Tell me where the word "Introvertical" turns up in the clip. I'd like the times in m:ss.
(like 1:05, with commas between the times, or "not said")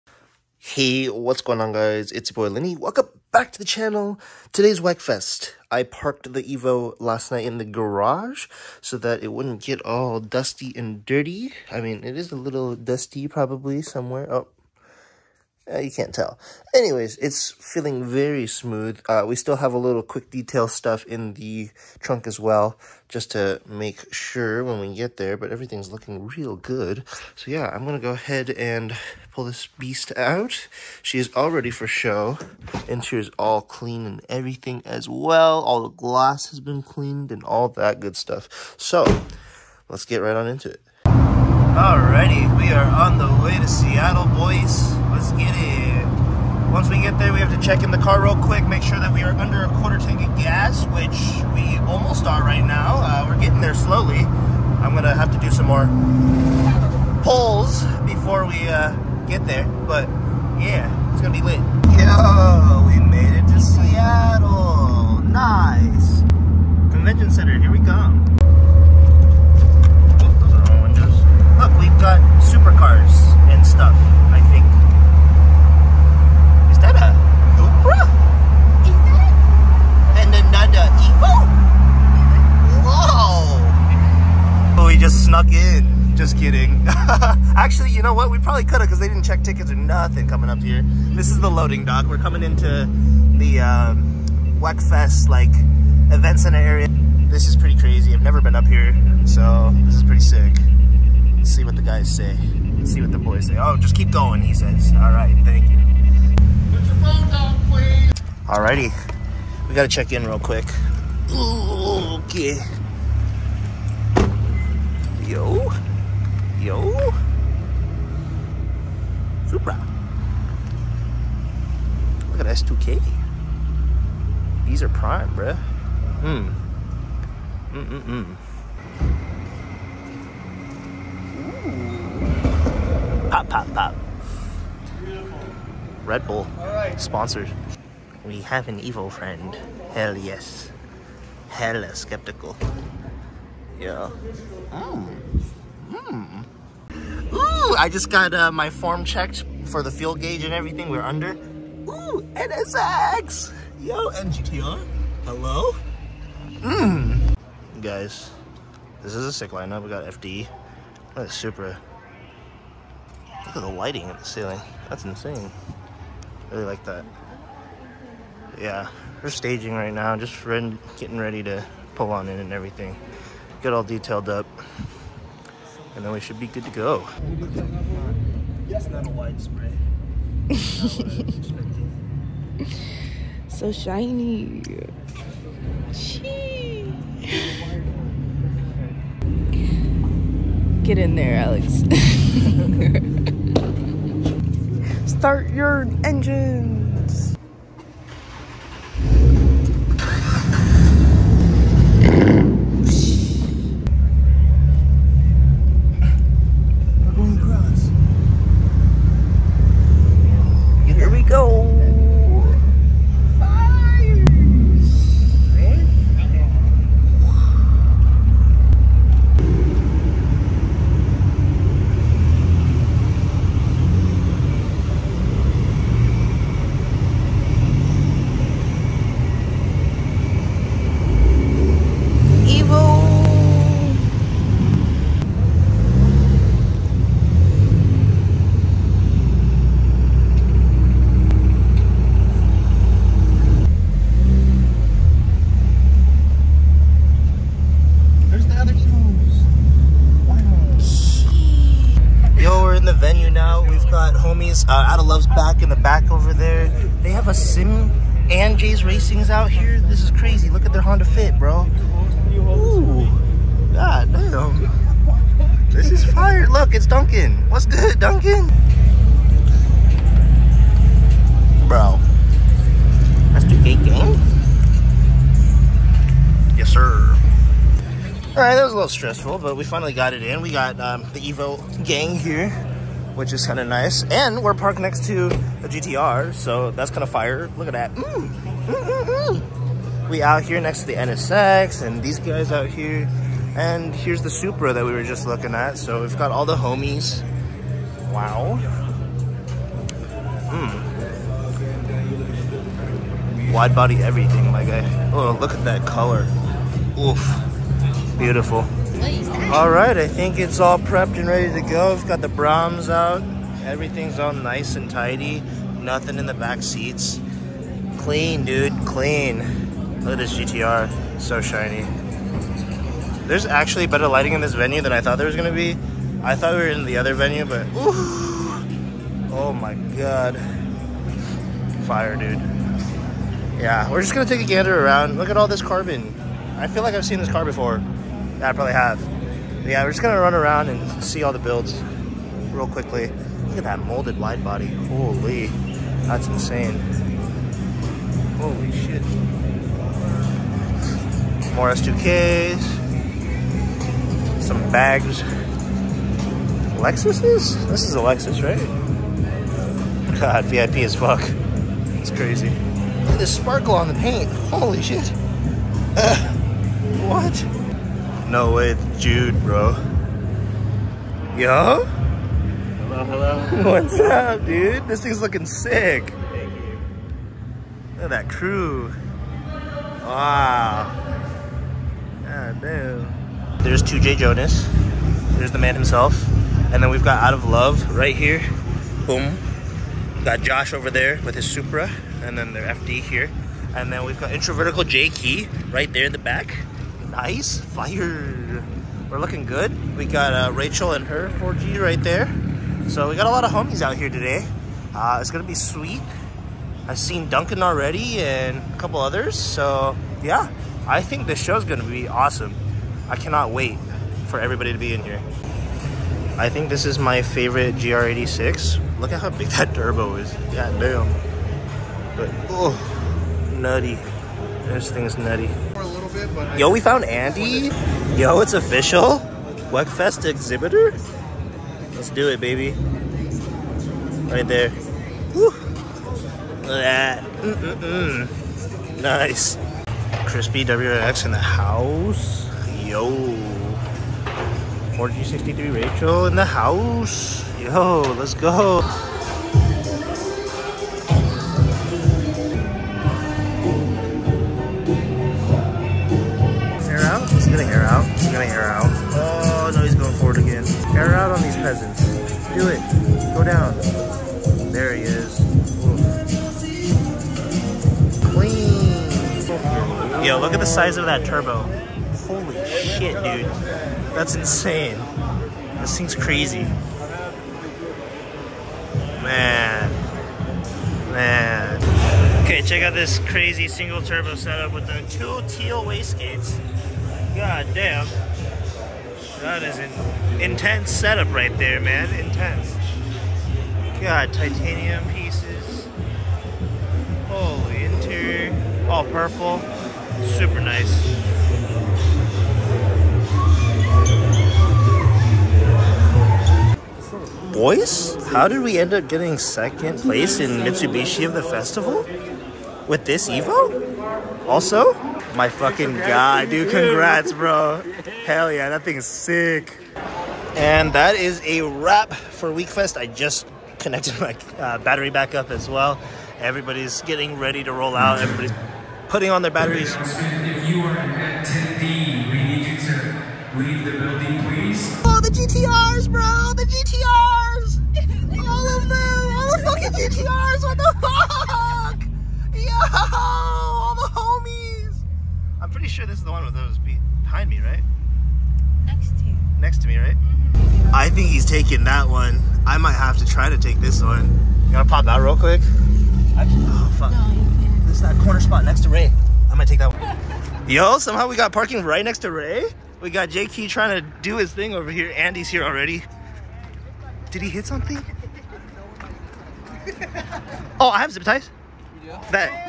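6:34.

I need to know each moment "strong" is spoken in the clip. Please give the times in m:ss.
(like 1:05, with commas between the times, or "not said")
not said.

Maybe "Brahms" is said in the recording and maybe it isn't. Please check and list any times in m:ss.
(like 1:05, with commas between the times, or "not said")
5:12.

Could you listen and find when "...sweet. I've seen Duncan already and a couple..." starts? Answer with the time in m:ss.
6:45.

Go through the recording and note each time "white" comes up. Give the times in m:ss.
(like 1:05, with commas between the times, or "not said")
2:59.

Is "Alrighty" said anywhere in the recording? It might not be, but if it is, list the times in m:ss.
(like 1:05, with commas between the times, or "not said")
0:41, 1:48.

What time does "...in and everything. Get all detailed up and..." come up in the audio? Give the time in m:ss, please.
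2:52.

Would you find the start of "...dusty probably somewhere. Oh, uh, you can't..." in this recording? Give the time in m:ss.
0:12.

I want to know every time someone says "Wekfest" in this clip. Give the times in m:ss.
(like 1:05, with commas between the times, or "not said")
0:04, 1:34, 7:09, 8:42.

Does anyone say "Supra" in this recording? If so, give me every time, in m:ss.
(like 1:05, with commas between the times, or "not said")
1:59, 2:41, 4:54, 6:31.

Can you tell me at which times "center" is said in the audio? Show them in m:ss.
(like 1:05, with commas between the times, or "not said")
1:07, 1:36.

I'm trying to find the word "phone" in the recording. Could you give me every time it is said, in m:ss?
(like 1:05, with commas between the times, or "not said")
1:46.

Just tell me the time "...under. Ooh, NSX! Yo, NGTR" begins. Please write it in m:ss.
2:31.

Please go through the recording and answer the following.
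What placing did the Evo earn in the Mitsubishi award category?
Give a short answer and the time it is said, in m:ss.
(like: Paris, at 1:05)
second place, at 8:29.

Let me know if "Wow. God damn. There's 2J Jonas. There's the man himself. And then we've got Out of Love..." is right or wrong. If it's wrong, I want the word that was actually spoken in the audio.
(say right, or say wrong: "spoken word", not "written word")
right.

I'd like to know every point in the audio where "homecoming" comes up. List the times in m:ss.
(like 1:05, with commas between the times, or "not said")
not said.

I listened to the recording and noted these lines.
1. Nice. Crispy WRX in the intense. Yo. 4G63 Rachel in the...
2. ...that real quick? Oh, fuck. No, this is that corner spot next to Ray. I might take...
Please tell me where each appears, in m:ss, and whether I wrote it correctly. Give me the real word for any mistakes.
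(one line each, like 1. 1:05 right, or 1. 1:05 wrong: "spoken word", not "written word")
1. 7:19 wrong: "house", not "intense"
2. 9:15 right.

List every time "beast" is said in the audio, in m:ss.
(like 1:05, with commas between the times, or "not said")
0:29.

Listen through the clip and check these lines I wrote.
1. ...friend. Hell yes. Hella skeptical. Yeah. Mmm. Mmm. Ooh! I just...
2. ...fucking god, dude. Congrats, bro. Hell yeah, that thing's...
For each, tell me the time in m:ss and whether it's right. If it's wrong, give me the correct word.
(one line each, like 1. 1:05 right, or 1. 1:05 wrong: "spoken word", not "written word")
1. 2:19 right
2. 8:35 right.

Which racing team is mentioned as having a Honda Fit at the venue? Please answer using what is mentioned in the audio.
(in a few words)
Jay's Racing.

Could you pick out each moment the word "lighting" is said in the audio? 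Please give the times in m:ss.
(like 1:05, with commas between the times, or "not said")
2:43, 5:24.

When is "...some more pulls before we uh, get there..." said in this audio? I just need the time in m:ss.
0:55.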